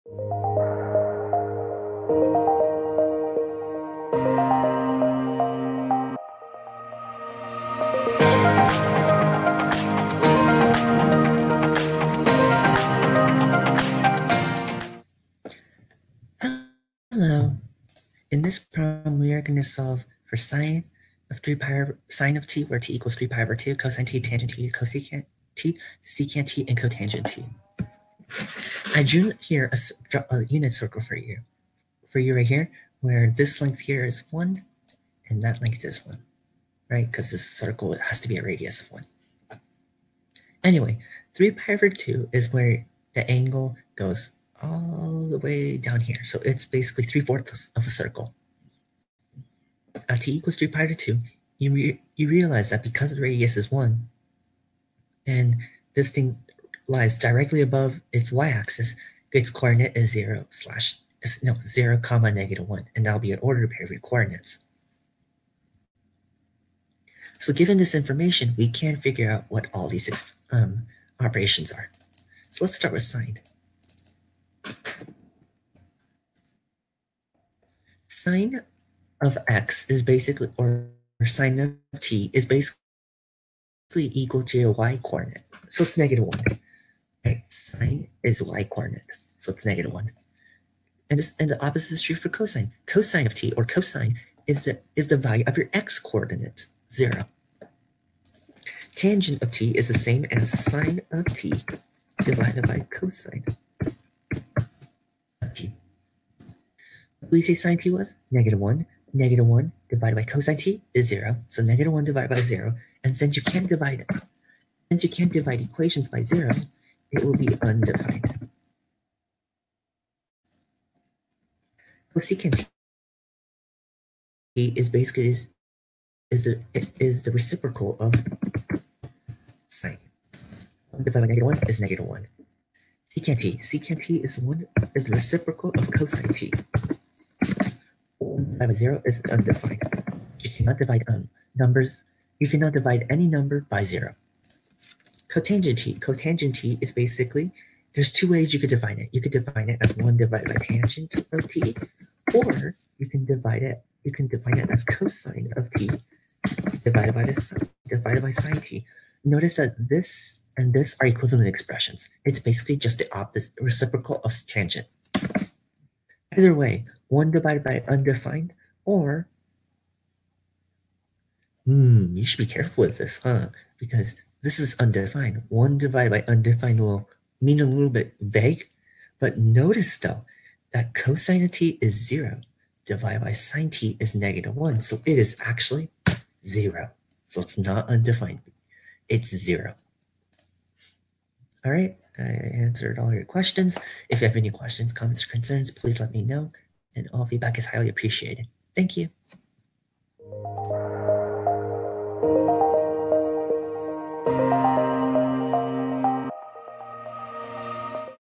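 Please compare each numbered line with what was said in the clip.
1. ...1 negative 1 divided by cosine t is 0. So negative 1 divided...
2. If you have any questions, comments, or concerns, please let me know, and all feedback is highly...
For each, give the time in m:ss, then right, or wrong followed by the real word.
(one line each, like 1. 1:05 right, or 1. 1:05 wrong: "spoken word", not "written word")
1. 1:48 right
2. 3:14 right.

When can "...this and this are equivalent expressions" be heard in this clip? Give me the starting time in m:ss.
2:39.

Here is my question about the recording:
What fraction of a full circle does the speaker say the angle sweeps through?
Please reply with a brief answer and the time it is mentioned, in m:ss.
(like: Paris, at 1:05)
3/4, at 0:47.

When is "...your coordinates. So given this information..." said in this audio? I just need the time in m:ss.
1:03.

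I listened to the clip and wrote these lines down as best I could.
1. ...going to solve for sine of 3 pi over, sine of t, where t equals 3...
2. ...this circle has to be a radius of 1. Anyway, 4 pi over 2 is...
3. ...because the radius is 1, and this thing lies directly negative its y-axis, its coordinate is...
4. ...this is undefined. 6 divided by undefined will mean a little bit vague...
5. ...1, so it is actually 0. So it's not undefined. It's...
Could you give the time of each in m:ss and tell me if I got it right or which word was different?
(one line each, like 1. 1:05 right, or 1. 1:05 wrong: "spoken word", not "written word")
1. 0:19 right
2. 0:37 wrong: "3", not "4"
3. 0:52 wrong: "above", not "negative"
4. 2:54 wrong: "1", not "6"
5. 3:04 right.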